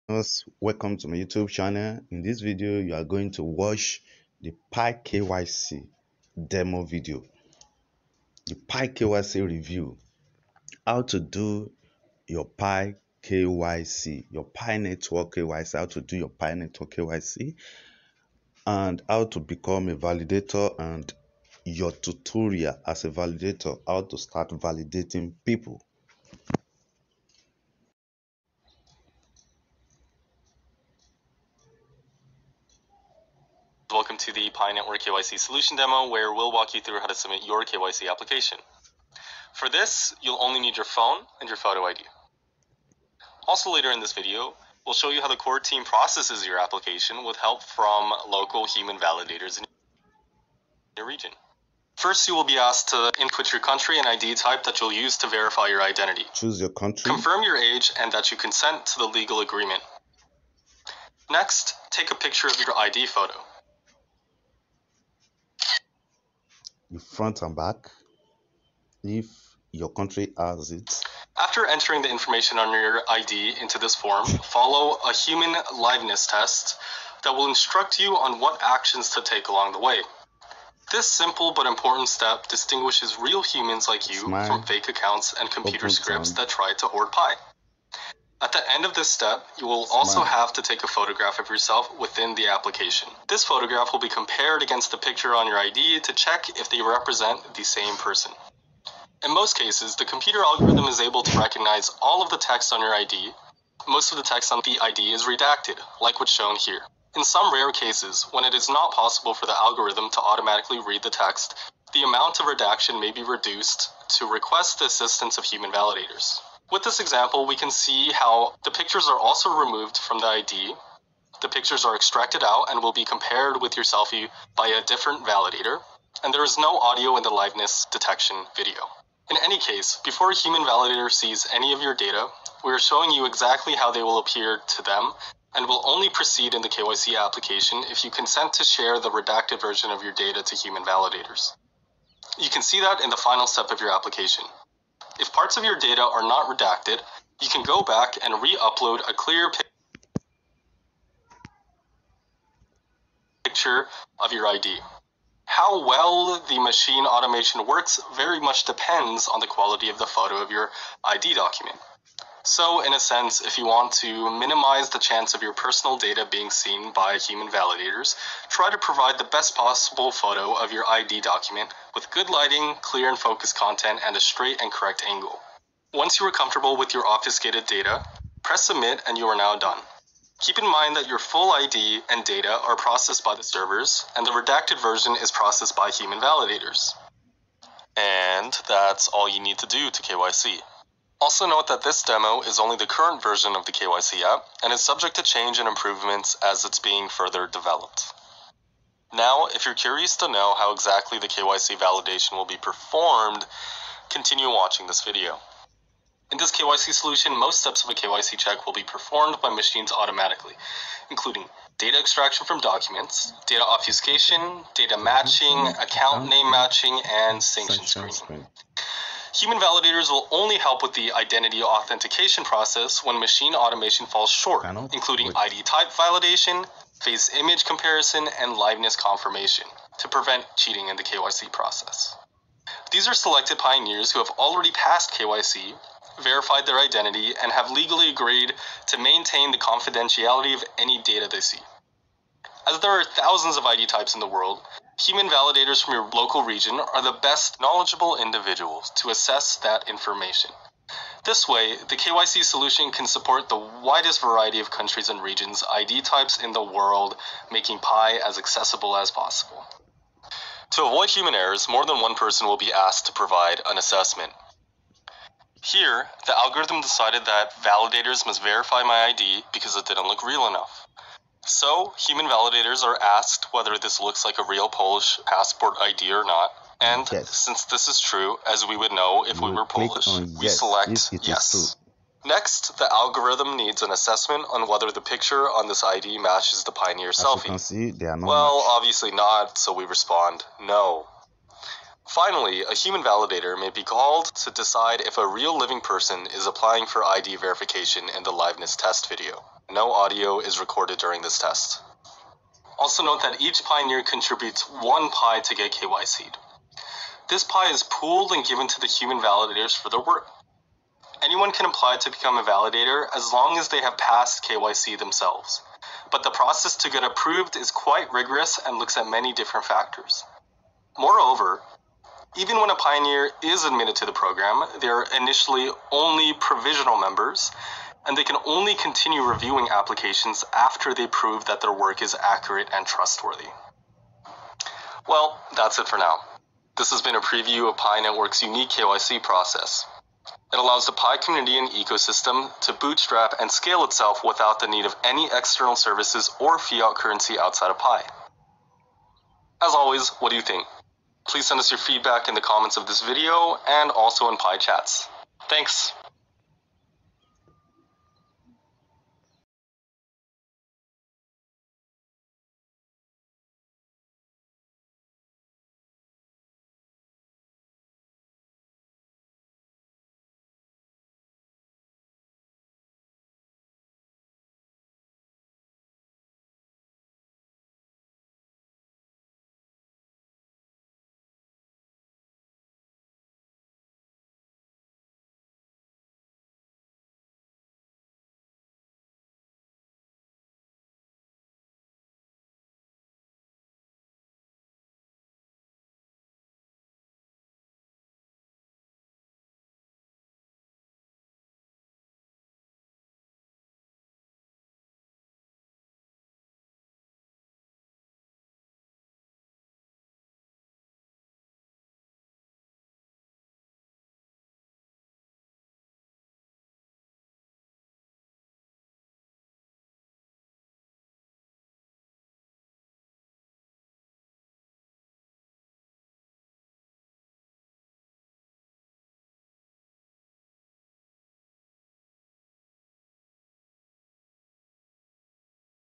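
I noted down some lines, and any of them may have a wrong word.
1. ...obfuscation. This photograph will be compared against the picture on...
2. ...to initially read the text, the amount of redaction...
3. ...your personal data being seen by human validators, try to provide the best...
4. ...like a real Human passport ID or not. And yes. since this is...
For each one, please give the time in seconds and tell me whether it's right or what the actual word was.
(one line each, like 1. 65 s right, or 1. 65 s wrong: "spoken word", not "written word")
1. 92 s wrong: "application", not "obfuscation"
2. 110 s wrong: "automatically", not "initially"
3. 165 s right
4. 274 s wrong: "Polish", not "Human".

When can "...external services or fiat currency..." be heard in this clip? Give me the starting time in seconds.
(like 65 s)
345 s.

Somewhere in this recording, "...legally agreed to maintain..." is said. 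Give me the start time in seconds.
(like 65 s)
237 s.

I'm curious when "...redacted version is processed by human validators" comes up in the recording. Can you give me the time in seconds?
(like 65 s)
184 s.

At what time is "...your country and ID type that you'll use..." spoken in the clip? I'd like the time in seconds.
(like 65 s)
53 s.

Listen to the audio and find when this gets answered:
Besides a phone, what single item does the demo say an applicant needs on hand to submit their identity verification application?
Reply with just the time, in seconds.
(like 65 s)
41 s.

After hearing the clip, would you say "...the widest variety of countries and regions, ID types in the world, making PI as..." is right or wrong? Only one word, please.
right.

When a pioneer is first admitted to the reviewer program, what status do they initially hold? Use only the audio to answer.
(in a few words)
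Provisional members.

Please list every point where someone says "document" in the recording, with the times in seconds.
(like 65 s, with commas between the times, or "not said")
161 s, 171 s, 212 s.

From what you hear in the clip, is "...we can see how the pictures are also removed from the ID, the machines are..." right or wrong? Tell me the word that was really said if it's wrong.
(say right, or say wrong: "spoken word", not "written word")
wrong: "pictures", not "machines".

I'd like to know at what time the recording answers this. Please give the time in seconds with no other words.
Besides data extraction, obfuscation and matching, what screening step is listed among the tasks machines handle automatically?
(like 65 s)
217 s.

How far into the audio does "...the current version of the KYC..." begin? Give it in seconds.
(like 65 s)
192 s.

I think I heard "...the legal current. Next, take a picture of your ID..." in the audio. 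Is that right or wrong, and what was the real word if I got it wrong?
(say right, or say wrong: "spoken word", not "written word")
wrong: "agreement", not "current".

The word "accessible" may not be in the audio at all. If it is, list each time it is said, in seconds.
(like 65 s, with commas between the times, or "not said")
258 s.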